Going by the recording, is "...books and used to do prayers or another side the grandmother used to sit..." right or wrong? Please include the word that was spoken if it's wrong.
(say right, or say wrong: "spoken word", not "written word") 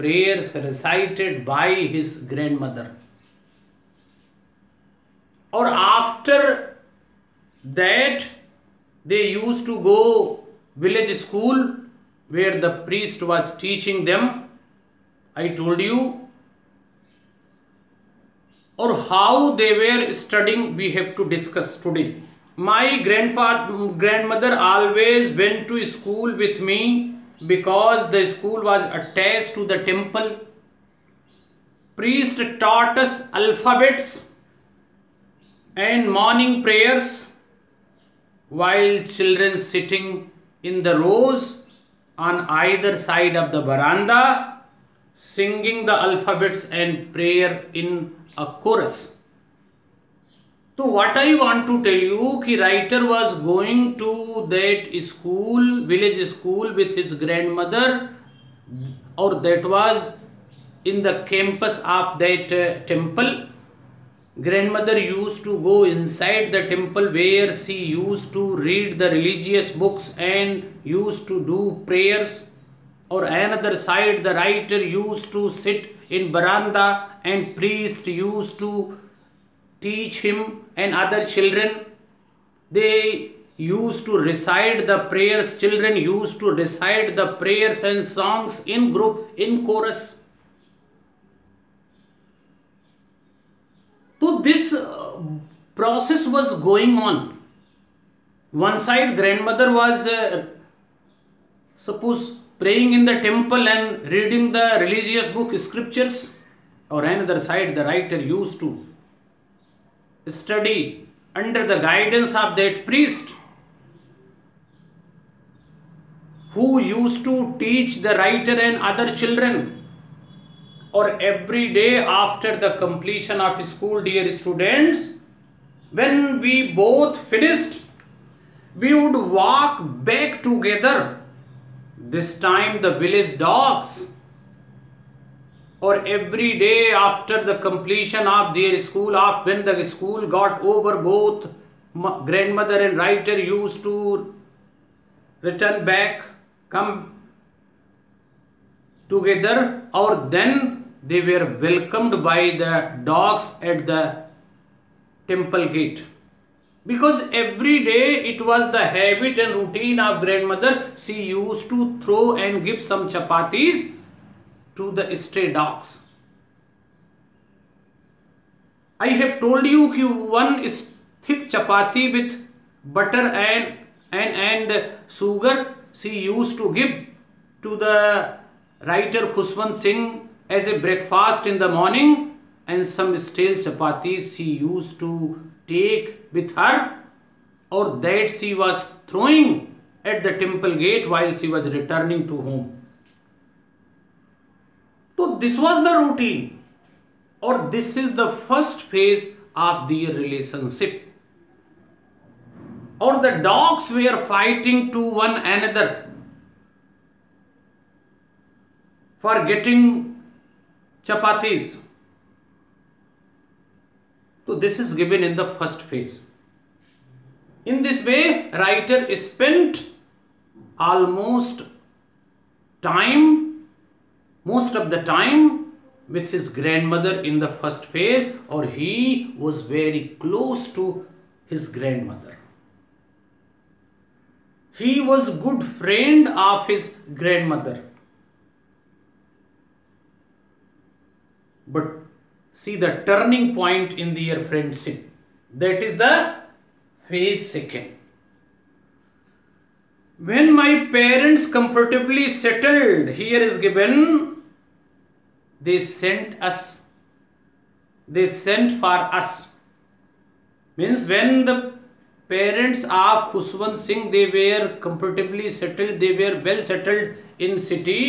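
wrong: "writer", not "grandmother".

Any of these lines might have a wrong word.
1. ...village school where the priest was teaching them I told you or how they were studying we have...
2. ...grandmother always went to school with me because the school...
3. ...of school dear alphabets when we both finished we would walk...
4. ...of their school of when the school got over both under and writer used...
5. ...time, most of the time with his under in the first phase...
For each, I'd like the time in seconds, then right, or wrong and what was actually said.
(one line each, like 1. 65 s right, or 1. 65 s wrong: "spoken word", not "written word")
1. 10 s right
2. 24 s right
3. 123 s wrong: "students", not "alphabets"
4. 138 s wrong: "grandmother", not "under"
5. 222 s wrong: "grandmother", not "under".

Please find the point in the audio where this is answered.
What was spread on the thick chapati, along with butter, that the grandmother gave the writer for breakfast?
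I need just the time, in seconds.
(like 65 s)
175 s.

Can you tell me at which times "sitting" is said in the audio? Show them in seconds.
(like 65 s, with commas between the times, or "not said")
39 s.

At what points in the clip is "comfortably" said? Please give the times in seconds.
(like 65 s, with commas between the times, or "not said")
251 s, 264 s.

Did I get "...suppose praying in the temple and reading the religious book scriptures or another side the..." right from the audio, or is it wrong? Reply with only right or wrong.
right.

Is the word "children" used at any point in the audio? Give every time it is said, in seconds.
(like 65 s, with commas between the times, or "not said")
39 s, 81 s, 85 s, 119 s.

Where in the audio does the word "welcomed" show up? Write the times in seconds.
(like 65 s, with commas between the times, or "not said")
151 s.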